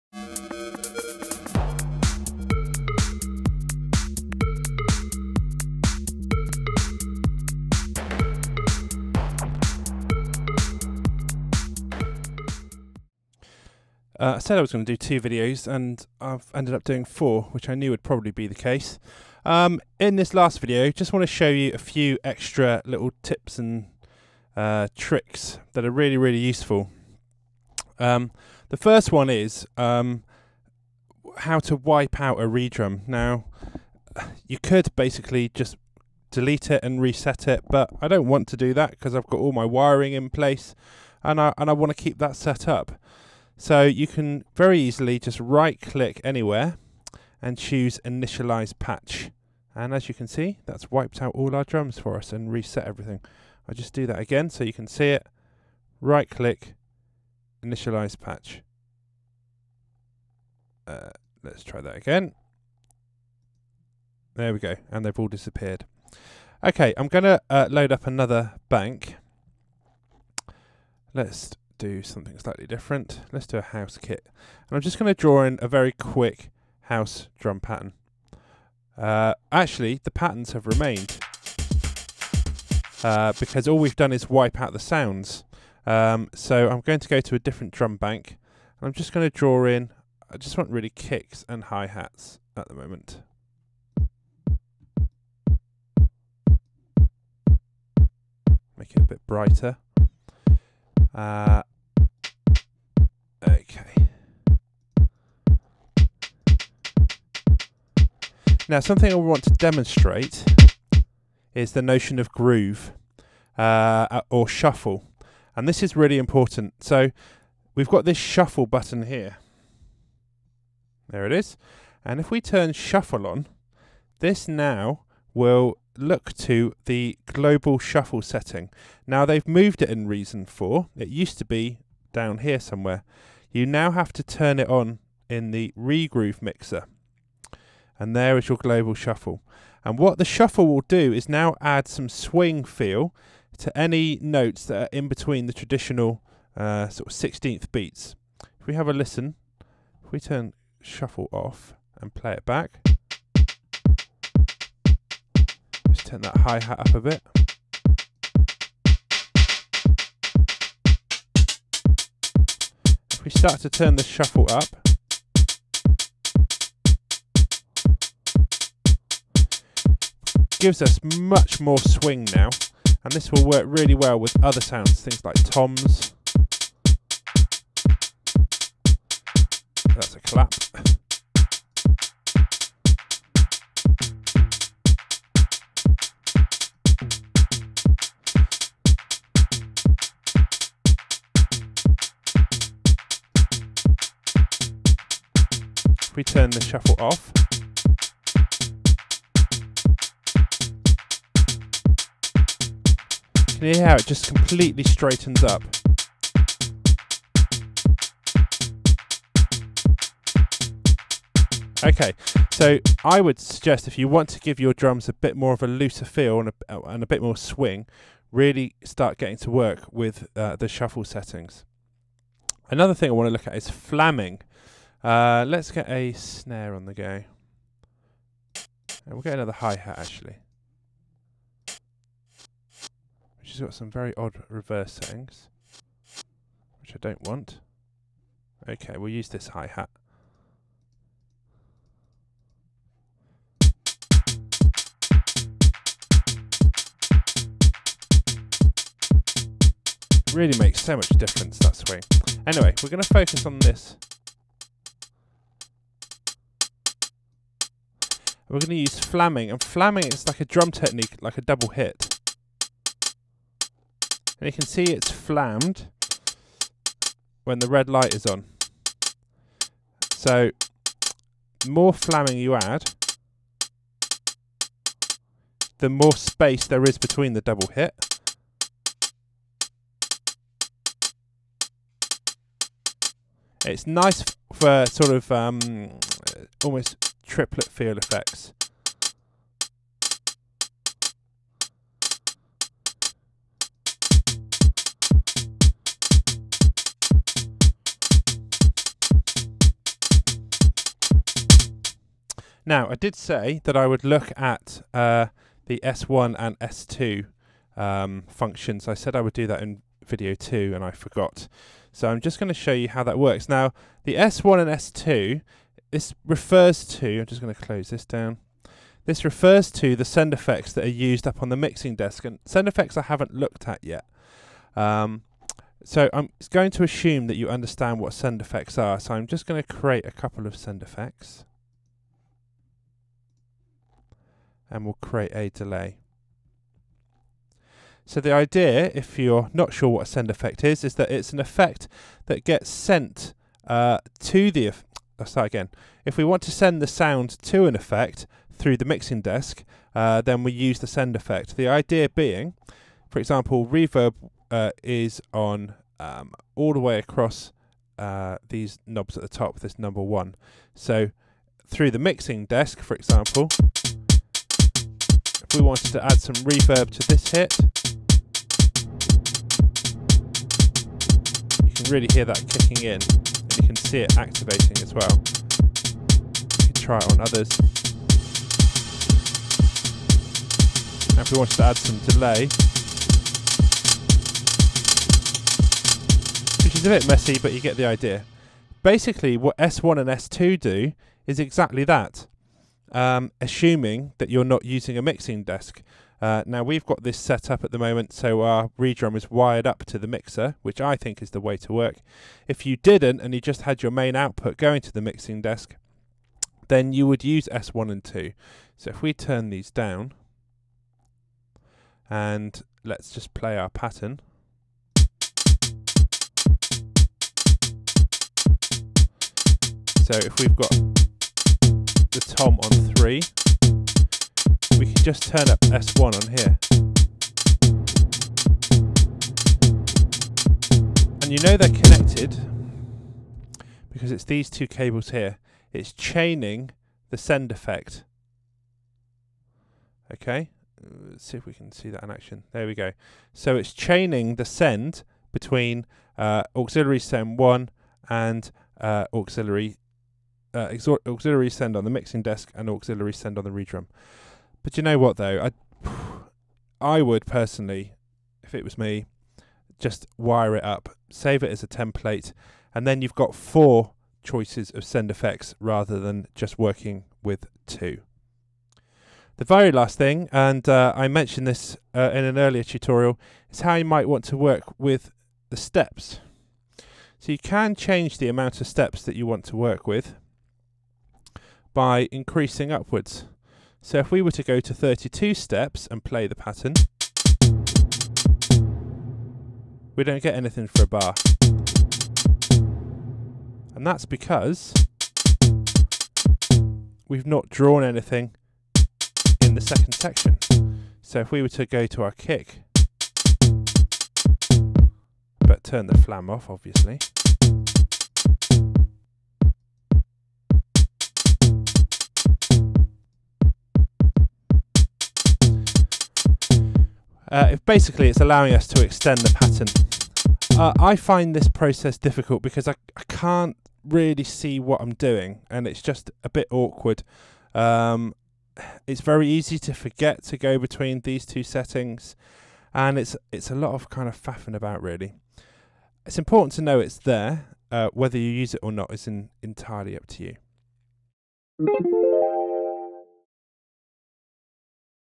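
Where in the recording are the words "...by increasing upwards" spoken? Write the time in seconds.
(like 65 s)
481 s.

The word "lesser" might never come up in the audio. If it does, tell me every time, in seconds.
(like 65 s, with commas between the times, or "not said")
not said.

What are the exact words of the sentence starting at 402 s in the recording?
If you didn't and you just had your main output going to the mixing desk, then you would use S1 and 2.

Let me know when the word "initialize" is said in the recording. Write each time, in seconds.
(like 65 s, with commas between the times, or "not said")
48 s, 57 s.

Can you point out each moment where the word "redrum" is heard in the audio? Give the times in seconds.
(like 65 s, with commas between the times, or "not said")
32 s, 398 s, 453 s.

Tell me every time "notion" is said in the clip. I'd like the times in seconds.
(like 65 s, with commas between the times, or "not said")
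111 s.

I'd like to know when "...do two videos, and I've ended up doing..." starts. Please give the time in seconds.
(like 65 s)
14 s.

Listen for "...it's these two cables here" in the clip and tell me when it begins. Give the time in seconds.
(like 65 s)
434 s.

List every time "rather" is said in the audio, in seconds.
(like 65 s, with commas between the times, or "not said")
465 s.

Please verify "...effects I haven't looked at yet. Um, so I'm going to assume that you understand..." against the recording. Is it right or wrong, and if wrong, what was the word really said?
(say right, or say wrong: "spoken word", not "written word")
right.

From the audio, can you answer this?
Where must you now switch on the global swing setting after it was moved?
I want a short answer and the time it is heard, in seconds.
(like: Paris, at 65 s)
Regroove mixer, at 135 s.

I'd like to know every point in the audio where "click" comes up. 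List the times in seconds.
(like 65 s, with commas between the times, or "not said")
45 s, 56 s.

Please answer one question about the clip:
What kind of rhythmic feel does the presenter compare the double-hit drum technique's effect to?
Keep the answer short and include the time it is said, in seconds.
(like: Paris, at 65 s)
Triplet feel, at 287 s.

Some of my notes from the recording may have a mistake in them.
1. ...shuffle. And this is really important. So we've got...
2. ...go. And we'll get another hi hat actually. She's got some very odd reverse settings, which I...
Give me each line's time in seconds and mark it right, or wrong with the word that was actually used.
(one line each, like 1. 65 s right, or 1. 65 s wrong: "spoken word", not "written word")
1. 114 s right
2. 226 s right.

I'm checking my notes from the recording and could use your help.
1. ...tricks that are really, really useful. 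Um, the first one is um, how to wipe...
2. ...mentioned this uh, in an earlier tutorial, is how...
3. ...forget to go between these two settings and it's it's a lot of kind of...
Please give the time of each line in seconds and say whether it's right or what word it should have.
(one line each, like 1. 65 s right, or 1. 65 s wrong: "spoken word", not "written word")
1. 24 s right
2. 471 s right
3. 529 s right.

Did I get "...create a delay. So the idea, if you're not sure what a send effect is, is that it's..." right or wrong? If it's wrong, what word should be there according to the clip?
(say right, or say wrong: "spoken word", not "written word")
right.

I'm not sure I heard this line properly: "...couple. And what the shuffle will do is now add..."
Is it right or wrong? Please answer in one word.
wrong.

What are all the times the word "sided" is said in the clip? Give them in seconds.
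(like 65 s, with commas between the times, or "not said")
not said.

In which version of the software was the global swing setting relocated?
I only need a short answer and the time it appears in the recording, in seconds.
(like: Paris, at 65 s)
Reason 4, at 130 s.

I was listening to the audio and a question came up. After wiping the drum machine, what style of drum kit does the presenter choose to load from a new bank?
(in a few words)
House kit.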